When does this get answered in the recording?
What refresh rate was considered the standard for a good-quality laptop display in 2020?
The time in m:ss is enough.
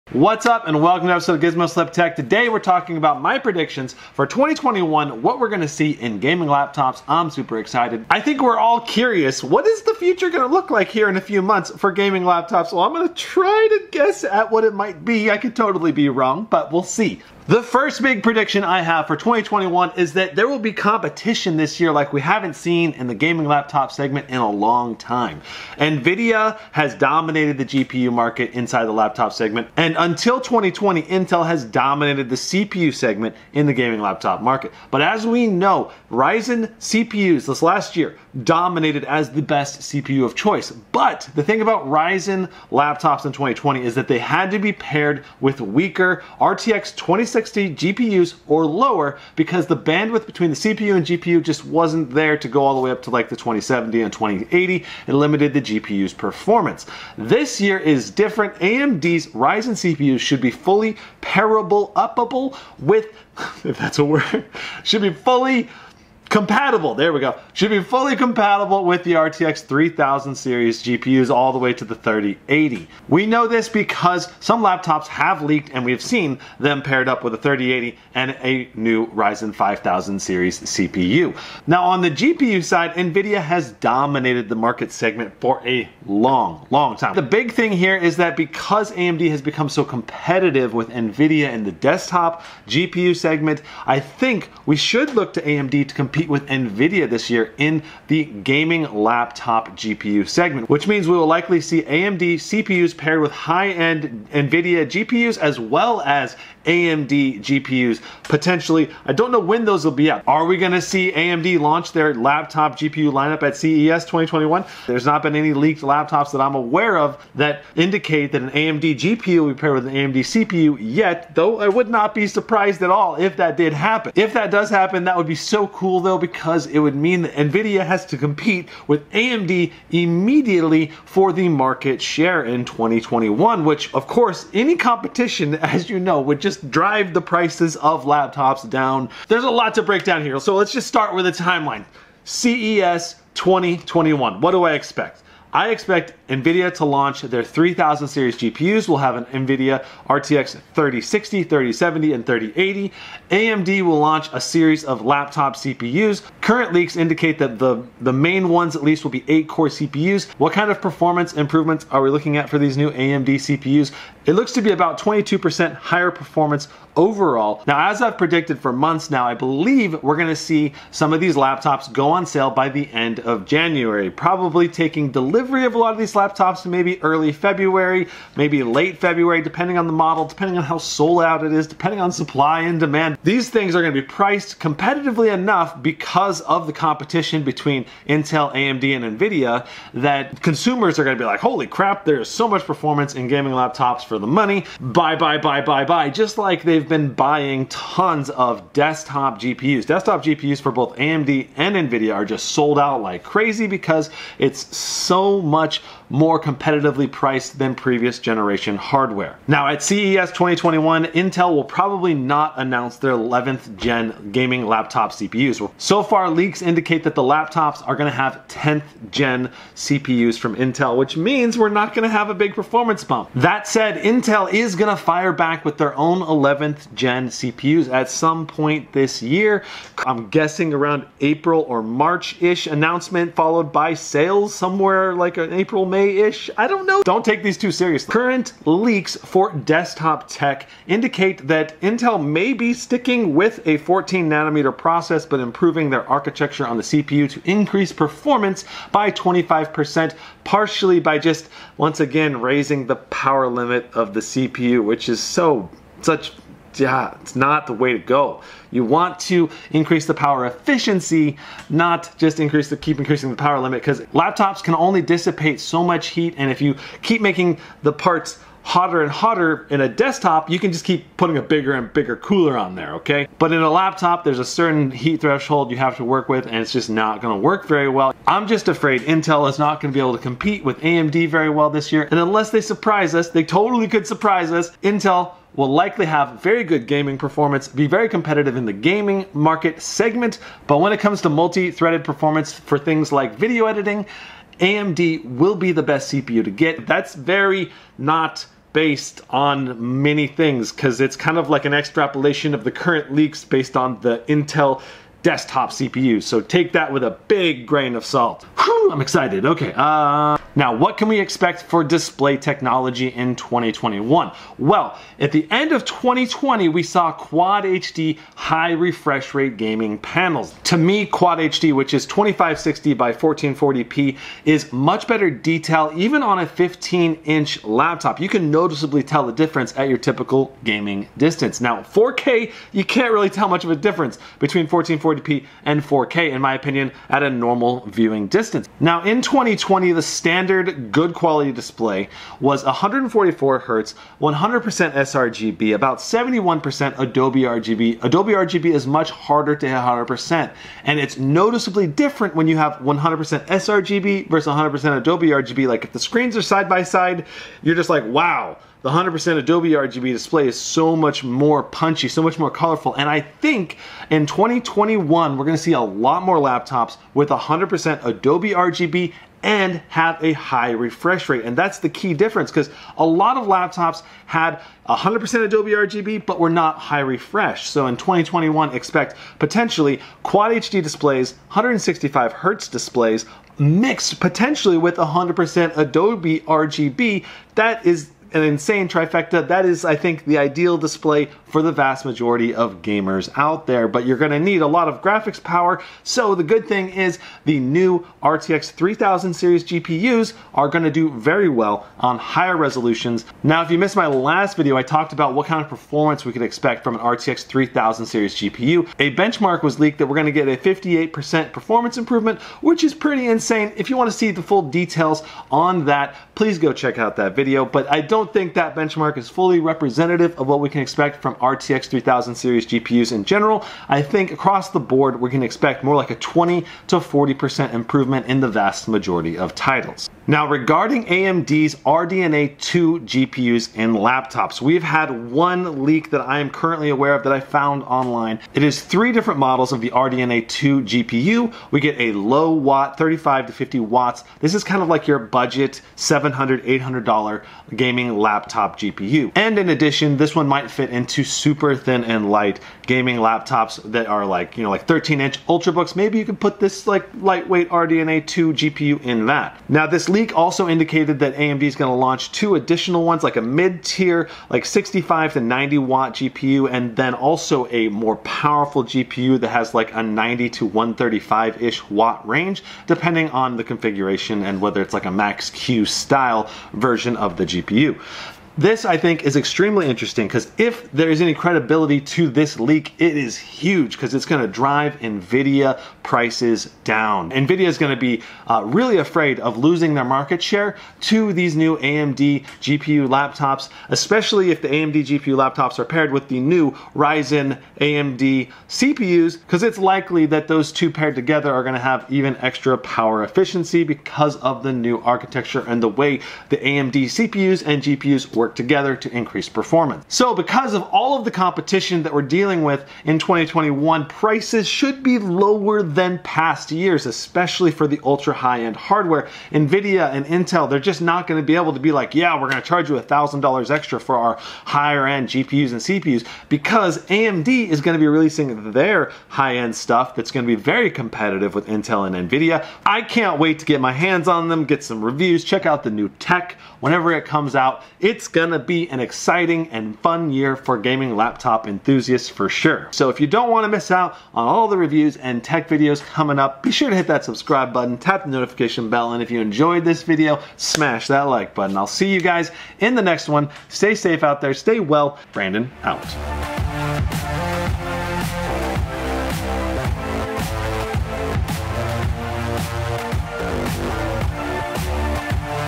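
5:42.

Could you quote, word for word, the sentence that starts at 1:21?
Now on the GPU side, NVIDIA has dominated the market segment for a long, long time.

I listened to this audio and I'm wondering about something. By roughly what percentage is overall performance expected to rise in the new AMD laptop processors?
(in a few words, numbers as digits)
22%.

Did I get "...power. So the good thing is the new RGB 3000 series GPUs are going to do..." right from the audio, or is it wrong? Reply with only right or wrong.
wrong.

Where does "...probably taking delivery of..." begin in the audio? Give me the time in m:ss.
2:54.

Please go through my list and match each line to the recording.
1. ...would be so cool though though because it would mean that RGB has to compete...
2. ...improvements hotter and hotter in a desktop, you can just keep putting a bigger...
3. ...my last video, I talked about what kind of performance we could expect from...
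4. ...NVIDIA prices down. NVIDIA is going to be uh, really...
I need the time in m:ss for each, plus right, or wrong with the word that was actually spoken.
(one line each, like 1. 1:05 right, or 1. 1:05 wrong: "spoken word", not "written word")
1. 2:05 wrong: "Nvidia", not "RGB"
2. 4:27 wrong: "parts", not "improvements"
3. 6:43 right
4. 8:04 right.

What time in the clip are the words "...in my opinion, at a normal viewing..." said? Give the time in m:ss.
5:36.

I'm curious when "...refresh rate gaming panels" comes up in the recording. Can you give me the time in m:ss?
5:18.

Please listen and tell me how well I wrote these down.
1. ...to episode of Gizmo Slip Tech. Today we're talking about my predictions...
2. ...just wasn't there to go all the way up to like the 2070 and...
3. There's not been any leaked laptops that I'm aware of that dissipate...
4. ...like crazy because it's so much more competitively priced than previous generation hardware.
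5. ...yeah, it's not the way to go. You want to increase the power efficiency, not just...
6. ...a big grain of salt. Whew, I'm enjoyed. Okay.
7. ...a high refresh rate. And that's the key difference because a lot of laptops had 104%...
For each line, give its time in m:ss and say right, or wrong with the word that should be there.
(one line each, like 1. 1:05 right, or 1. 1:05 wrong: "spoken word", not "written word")
1. 0:01 right
2. 0:51 right
3. 1:54 wrong: "indicate", not "dissipate"
4. 3:23 right
5. 4:16 right
6. 5:07 wrong: "excited", not "enjoyed"
7. 6:10 wrong: "100", not "104".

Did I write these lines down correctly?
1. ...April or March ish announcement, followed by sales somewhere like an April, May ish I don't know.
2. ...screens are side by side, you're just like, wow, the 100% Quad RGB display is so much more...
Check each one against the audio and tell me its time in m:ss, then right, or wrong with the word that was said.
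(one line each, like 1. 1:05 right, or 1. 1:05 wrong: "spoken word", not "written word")
1. 3:51 right
2. 5:55 wrong: "Adobe", not "Quad".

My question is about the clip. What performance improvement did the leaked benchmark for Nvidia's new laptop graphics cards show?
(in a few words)
58%.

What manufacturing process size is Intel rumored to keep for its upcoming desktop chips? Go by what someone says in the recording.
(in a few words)
14 nanometer.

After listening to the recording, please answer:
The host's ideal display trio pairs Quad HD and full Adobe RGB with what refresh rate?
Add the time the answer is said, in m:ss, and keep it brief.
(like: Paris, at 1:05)
165 hertz, at 6:21.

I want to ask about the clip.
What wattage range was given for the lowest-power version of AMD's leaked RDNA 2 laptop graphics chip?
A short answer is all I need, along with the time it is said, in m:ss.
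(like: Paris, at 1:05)
35 to 50 watts, at 7:22.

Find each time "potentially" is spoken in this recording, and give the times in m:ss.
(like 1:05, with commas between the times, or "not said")
1:48, 6:19, 6:24.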